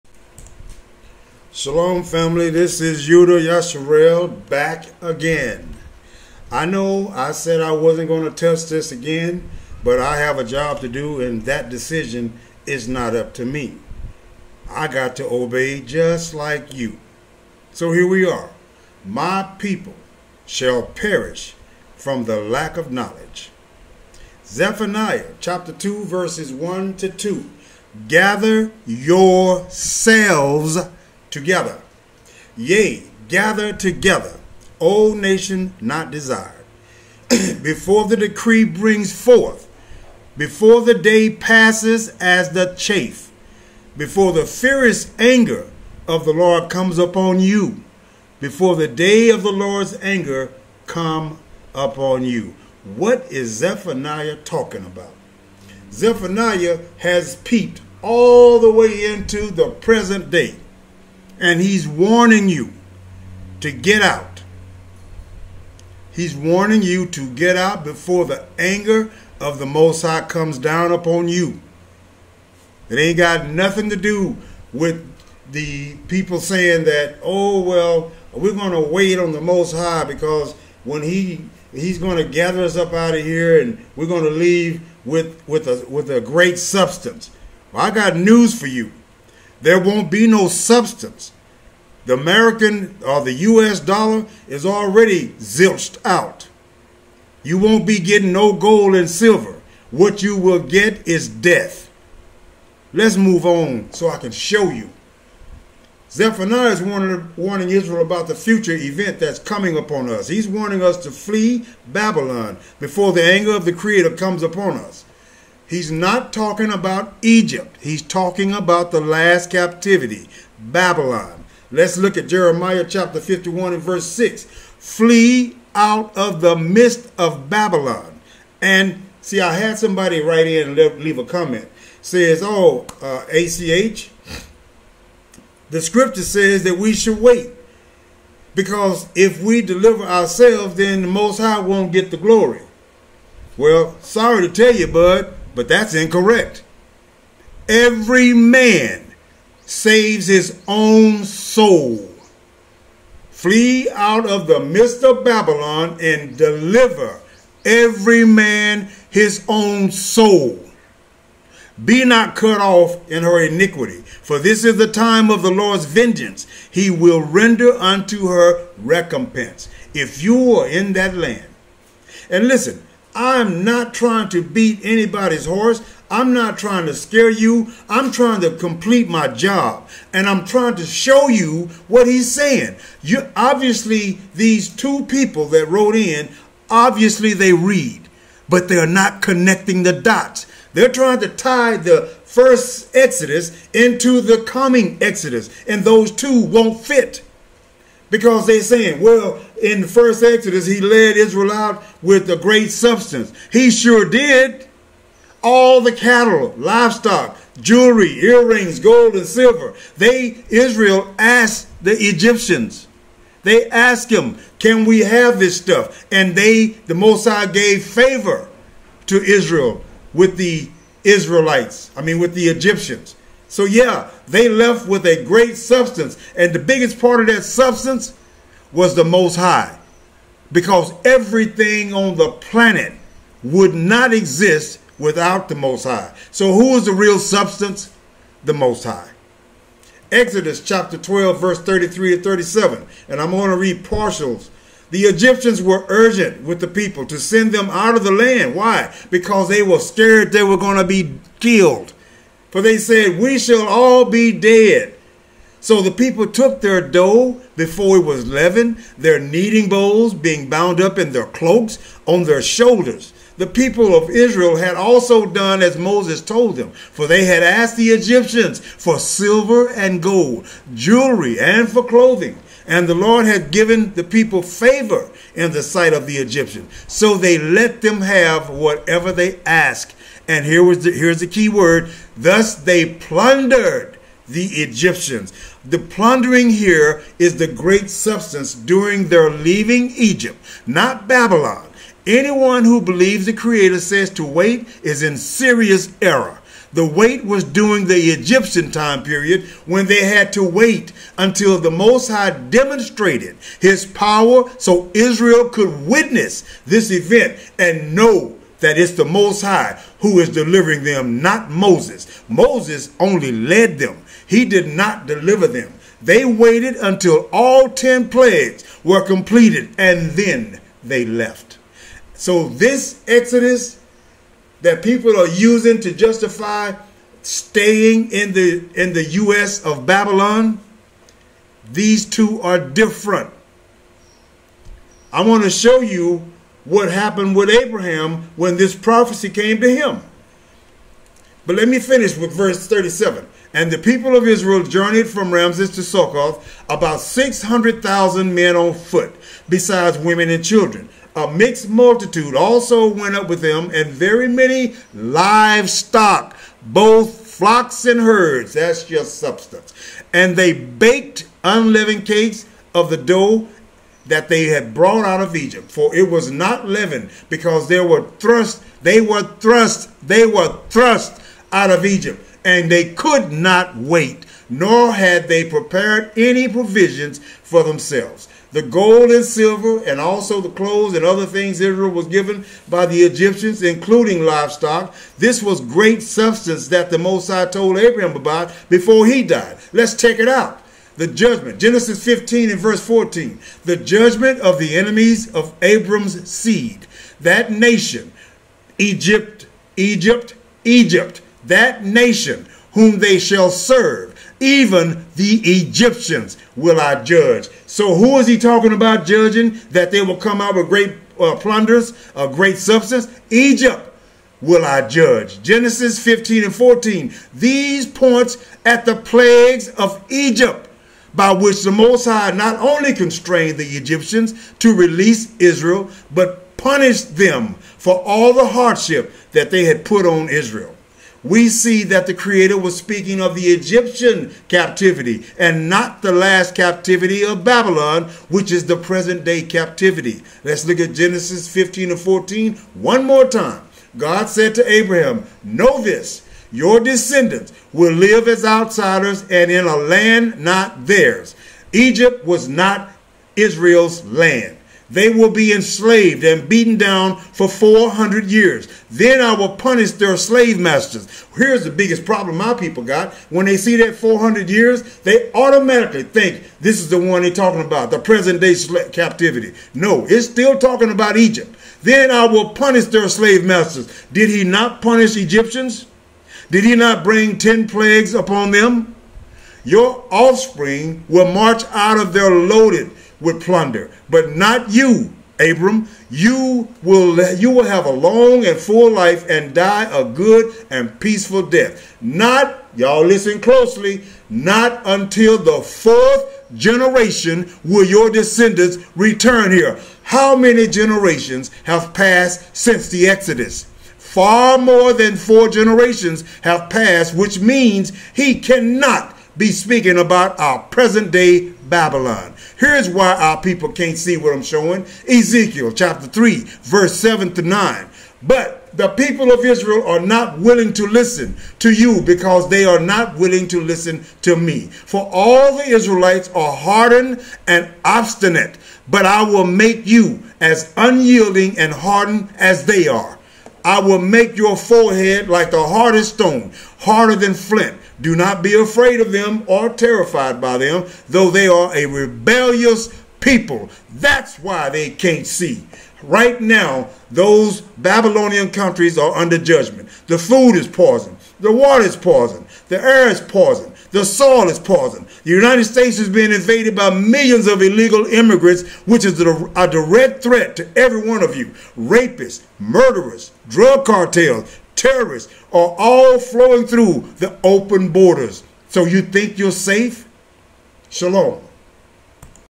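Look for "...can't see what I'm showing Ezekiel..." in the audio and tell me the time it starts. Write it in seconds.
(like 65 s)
513 s.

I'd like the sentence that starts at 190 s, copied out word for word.
They're trying to tie the first Exodus into the coming Exodus, and those two won't fit.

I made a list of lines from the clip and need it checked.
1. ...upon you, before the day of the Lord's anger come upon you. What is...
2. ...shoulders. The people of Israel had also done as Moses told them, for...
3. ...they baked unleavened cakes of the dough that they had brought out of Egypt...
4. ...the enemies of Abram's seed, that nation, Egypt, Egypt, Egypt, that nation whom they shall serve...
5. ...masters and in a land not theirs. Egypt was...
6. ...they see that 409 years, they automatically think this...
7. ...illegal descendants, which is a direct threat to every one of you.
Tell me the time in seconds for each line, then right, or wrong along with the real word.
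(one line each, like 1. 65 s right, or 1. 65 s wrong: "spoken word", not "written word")
1. 46 s right
2. 262 s right
3. 360 s right
4. 394 s right
5. 448 s wrong: "outsiders", not "masters"
6. 463 s wrong: "400", not "409"
7. 557 s wrong: "immigrants", not "descendants".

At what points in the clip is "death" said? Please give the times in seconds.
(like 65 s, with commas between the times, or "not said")
101 s, 491 s.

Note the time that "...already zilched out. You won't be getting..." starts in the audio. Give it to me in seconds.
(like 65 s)
94 s.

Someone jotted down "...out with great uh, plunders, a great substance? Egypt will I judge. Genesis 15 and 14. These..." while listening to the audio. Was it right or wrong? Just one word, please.
right.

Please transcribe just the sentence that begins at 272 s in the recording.
And the Lord had given the people favor in the sight of the Egyptians.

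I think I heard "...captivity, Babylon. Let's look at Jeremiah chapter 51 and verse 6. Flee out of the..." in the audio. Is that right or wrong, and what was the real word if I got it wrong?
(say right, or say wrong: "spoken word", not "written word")
right.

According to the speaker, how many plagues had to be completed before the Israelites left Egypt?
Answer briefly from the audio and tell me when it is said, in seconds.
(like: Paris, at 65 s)
10, at 317 s.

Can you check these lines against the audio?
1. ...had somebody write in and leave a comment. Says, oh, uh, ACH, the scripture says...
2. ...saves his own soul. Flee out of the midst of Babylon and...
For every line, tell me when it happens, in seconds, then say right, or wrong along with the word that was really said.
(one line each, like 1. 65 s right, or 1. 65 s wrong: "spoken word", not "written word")
1. 129 s right
2. 149 s right.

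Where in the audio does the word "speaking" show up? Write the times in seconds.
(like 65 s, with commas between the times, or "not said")
432 s, 509 s.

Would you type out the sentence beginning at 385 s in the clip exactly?
This was great substance that the Most told Abraham about before he died.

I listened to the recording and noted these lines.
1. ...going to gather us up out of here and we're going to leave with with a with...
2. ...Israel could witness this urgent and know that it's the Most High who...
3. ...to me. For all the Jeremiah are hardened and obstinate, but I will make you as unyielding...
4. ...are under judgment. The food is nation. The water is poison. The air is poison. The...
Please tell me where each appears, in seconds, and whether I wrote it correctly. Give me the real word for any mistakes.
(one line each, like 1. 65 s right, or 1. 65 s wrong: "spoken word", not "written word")
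1. 81 s right
2. 304 s wrong: "event", not "urgent"
3. 524 s wrong: "Israelites", not "Jeremiah"
4. 548 s wrong: "poison", not "nation".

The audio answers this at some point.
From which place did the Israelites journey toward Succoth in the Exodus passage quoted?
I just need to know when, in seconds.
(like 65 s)
345 s.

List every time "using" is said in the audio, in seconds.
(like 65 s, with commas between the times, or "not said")
325 s.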